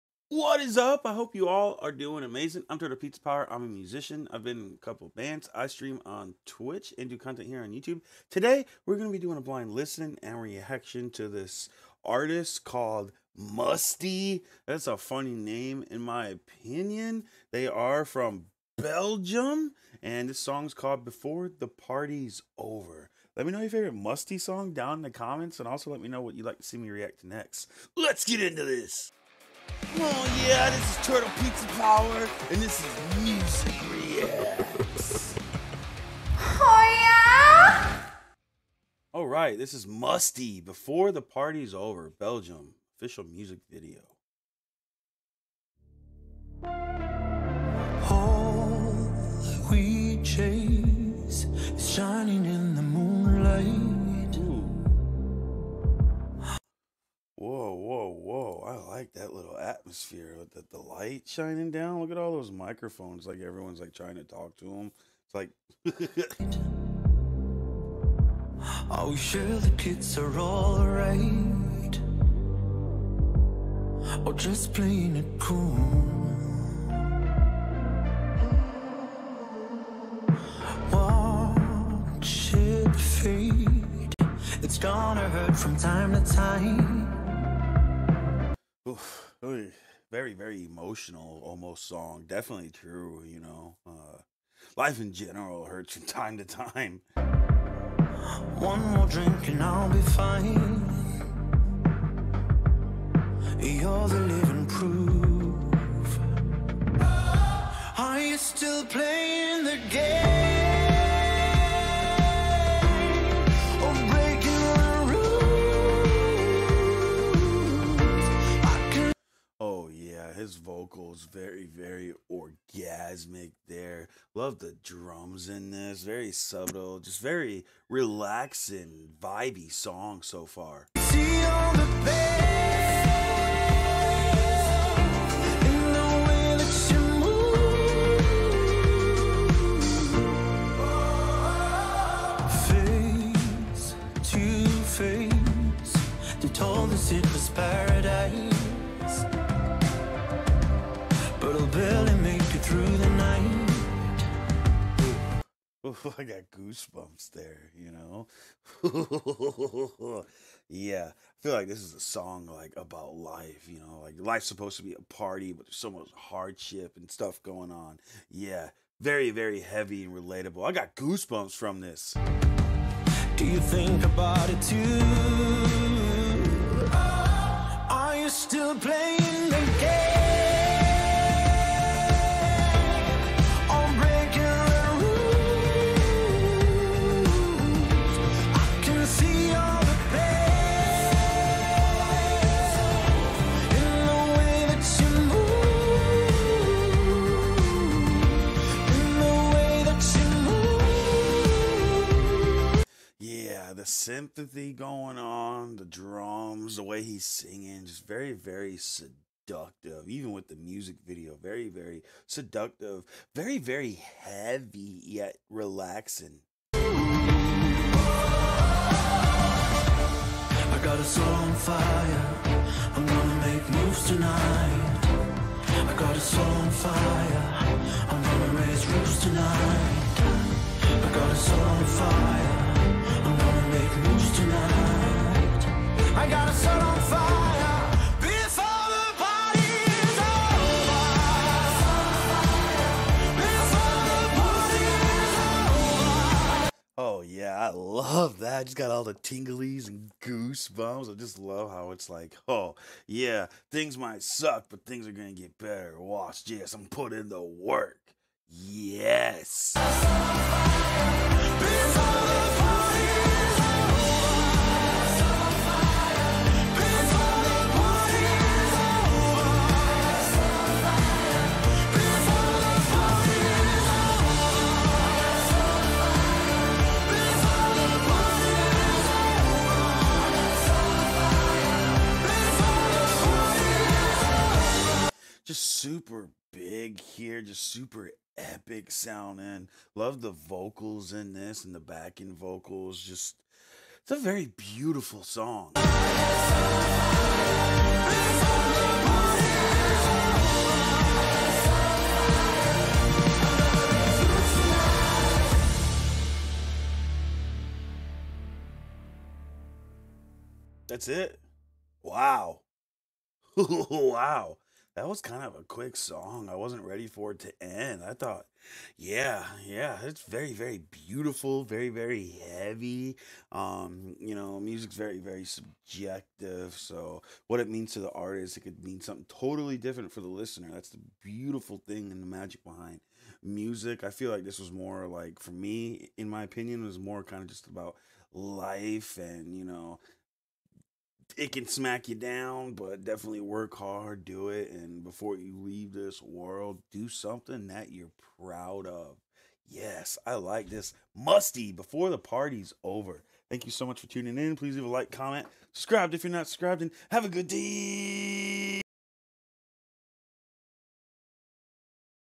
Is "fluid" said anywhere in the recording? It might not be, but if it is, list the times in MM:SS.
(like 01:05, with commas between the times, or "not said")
not said.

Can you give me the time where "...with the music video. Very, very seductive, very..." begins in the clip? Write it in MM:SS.
03:30.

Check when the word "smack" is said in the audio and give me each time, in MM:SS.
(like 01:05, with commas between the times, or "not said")
05:41.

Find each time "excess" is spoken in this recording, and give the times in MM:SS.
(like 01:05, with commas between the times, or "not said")
not said.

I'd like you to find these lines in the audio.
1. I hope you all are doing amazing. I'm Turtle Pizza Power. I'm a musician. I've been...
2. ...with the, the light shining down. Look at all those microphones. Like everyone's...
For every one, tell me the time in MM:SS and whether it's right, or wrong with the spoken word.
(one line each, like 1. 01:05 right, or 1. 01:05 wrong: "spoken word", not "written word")
1. 00:01 right
2. 01:00 right.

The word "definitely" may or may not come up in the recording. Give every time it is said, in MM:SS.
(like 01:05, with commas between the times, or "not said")
01:32, 05:43.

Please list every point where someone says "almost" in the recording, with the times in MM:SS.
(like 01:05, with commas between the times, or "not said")
01:31.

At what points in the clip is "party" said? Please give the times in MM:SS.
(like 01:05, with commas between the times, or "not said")
00:21, 00:41, 02:45, 05:52.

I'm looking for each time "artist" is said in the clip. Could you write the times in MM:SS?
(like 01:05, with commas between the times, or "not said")
00:12, 05:28.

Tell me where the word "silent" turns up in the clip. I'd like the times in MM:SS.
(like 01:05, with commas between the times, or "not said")
not said.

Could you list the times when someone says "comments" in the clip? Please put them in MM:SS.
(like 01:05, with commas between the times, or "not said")
00:25, 05:55.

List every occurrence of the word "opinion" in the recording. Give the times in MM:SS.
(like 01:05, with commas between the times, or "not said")
00:16, 05:36.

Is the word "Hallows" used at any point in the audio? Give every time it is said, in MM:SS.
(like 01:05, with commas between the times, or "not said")
not said.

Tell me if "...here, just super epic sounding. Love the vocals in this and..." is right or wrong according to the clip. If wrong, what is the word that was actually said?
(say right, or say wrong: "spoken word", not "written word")
right.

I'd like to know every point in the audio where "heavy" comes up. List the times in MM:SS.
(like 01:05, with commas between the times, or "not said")
02:49, 03:34, 05:22.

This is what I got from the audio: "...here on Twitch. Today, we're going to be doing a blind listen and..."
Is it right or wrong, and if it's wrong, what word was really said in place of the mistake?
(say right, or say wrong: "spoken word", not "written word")
wrong: "YouTube", not "Twitch".